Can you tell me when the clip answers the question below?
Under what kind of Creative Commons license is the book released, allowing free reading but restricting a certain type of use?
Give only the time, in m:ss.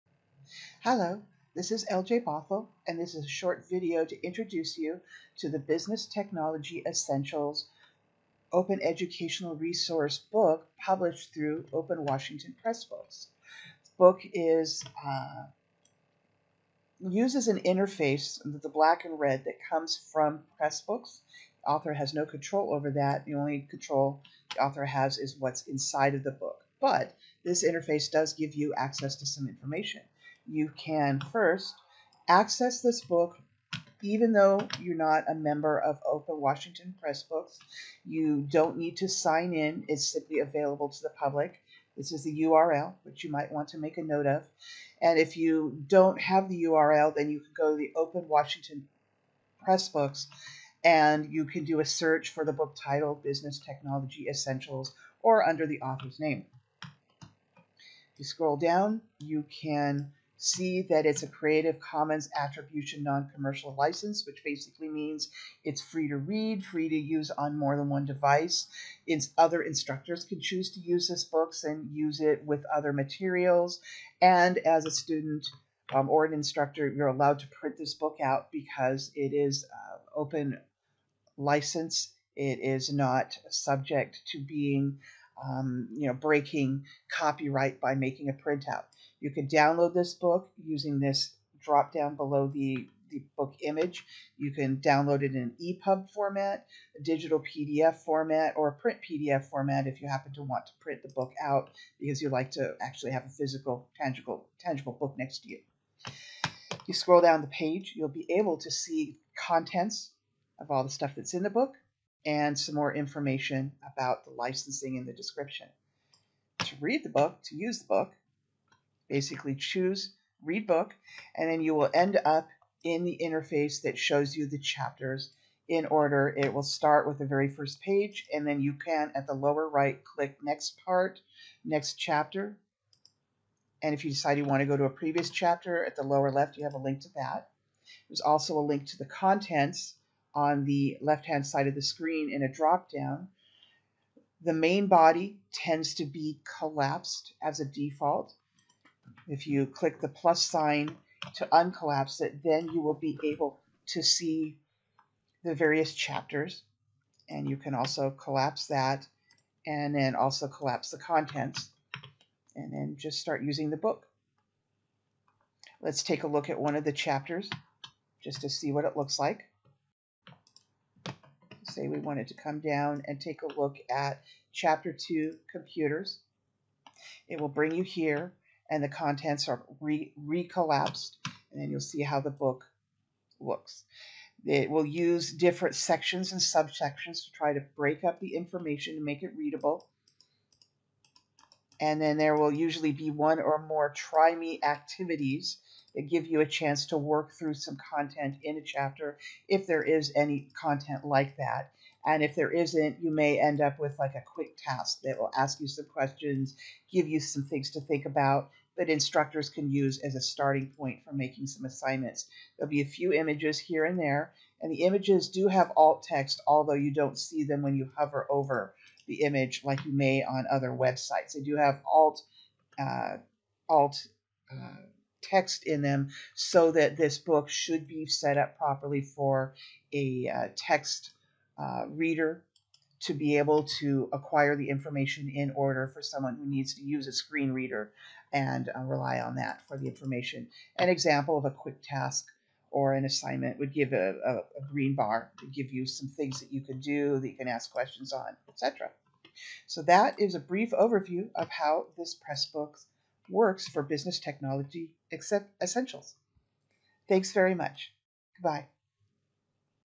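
1:02.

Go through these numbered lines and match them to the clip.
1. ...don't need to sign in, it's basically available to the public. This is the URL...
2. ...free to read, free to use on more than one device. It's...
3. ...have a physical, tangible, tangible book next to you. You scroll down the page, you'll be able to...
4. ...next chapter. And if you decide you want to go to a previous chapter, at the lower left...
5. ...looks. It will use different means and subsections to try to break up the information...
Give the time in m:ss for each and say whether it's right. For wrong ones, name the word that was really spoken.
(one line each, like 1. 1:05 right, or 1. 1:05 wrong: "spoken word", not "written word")
1. 0:38 wrong: "simply", not "basically"
2. 1:05 right
3. 1:43 right
4. 2:11 right
5. 3:03 wrong: "sections", not "means".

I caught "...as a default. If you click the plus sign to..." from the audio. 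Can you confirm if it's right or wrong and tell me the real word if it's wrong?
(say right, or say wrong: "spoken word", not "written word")
right.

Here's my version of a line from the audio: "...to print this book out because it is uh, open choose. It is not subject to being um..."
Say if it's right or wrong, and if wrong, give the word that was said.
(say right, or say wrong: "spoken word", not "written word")
wrong: "license", not "choose".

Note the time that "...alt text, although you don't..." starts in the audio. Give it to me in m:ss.
3:35.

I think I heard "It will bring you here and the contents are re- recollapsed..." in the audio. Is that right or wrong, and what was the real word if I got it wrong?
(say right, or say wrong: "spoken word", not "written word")
right.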